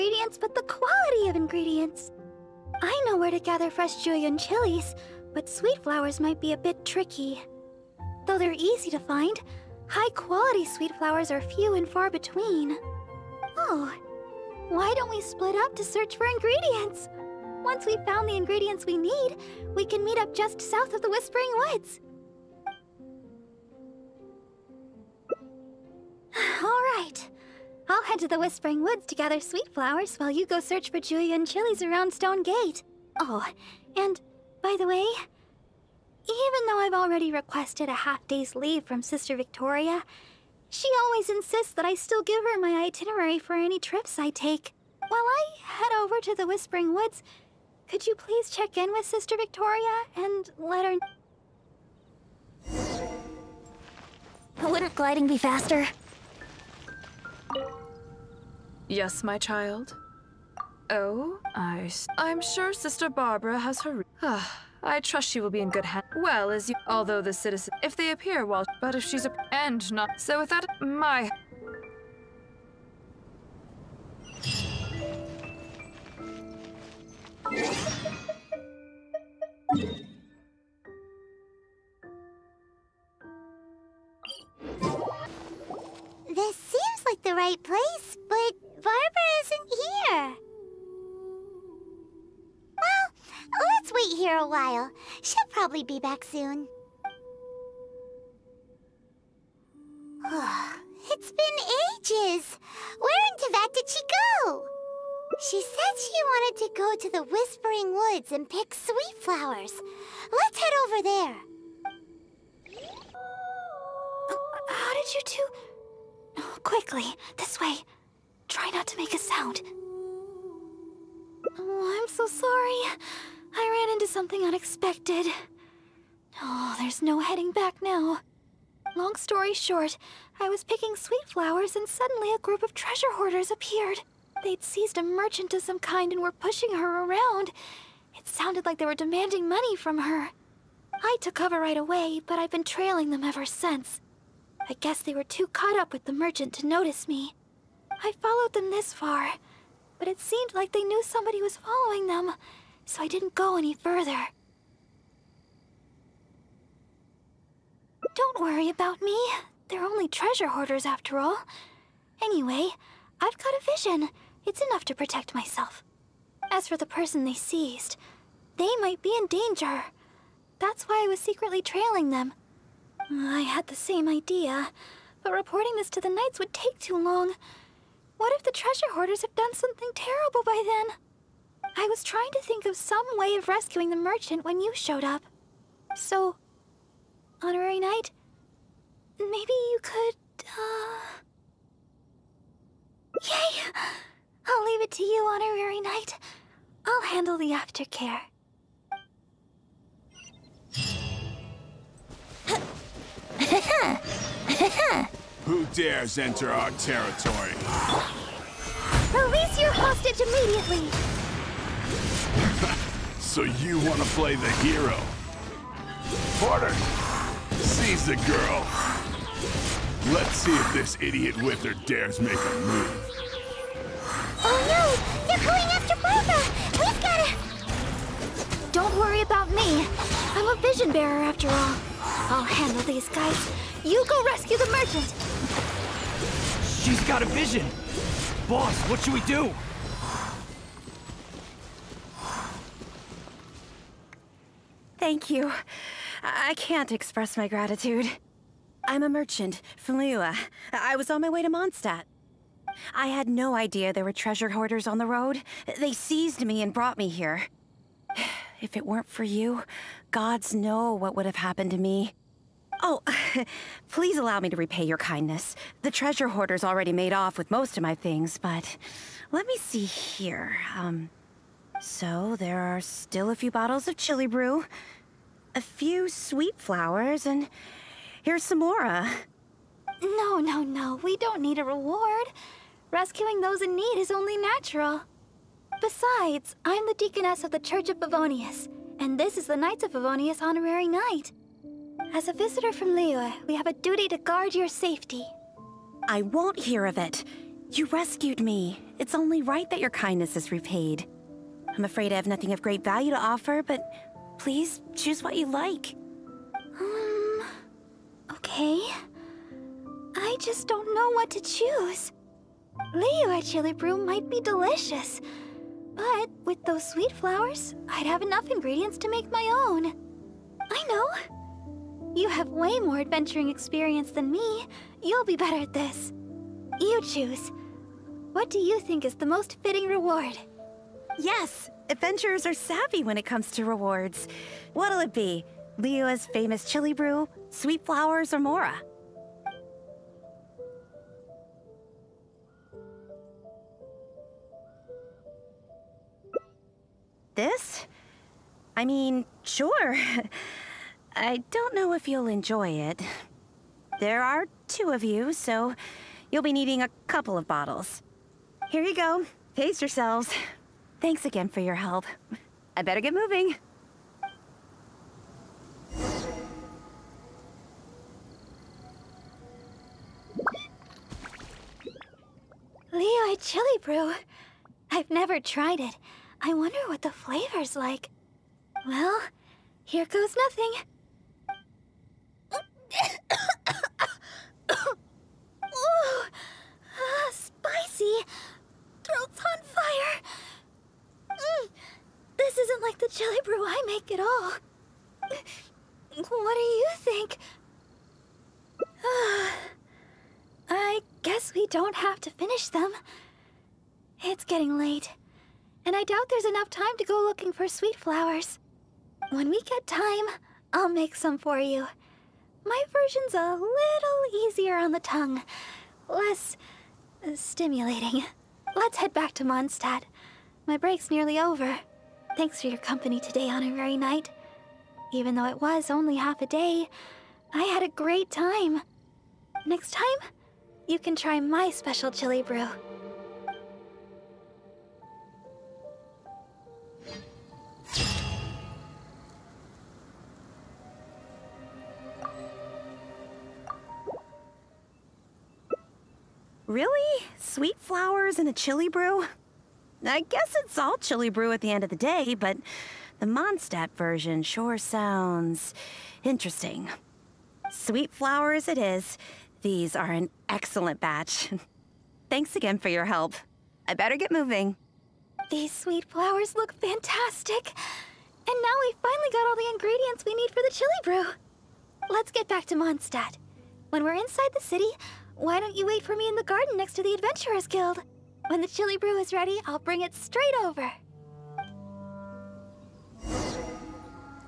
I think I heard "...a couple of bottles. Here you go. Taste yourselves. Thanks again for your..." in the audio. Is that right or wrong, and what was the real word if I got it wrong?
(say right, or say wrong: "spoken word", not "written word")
right.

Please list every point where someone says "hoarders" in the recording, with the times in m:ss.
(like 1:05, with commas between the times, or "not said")
2:13, 2:40, 2:58, 4:14, 4:26.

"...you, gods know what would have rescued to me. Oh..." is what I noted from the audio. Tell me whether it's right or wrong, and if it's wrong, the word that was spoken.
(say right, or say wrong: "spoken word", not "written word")
wrong: "happened", not "rescued".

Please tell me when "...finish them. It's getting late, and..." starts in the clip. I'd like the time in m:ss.
6:42.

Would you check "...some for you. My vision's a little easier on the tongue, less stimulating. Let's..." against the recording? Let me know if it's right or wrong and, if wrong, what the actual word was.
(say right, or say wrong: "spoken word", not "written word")
wrong: "version", not "vision".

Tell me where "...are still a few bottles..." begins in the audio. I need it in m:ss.
4:32.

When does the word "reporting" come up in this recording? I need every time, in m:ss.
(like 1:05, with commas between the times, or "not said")
2:55.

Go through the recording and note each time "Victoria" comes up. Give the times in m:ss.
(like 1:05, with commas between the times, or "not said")
0:39, 0:49.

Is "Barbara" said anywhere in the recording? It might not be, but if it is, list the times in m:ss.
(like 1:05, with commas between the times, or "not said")
1:03, 1:28, 3:45.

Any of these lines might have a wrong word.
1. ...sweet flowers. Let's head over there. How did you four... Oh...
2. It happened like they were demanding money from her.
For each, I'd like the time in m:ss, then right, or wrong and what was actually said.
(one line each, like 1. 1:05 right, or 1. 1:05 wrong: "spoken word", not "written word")
1. 1:48 wrong: "two", not "four"
2. 2:18 wrong: "sounded", not "happened".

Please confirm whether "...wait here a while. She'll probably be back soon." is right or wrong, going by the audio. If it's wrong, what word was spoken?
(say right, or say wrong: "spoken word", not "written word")
right.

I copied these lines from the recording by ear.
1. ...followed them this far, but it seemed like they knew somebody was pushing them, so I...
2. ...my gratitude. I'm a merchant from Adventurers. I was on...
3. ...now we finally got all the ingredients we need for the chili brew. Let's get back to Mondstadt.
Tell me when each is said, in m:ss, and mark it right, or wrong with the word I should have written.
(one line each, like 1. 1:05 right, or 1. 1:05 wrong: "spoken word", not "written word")
1. 2:28 wrong: "following", not "pushing"
2. 4:07 wrong: "Liyue", not "Adventurers"
3. 7:48 right.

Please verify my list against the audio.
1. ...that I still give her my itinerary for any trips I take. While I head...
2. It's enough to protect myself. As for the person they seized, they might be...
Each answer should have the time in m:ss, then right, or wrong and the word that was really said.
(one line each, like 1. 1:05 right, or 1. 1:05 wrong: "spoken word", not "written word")
1. 0:41 right
2. 2:44 right.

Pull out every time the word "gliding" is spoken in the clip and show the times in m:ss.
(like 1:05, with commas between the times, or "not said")
0:54.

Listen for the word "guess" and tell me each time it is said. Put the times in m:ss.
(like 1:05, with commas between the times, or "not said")
2:24, 6:41, 7:30.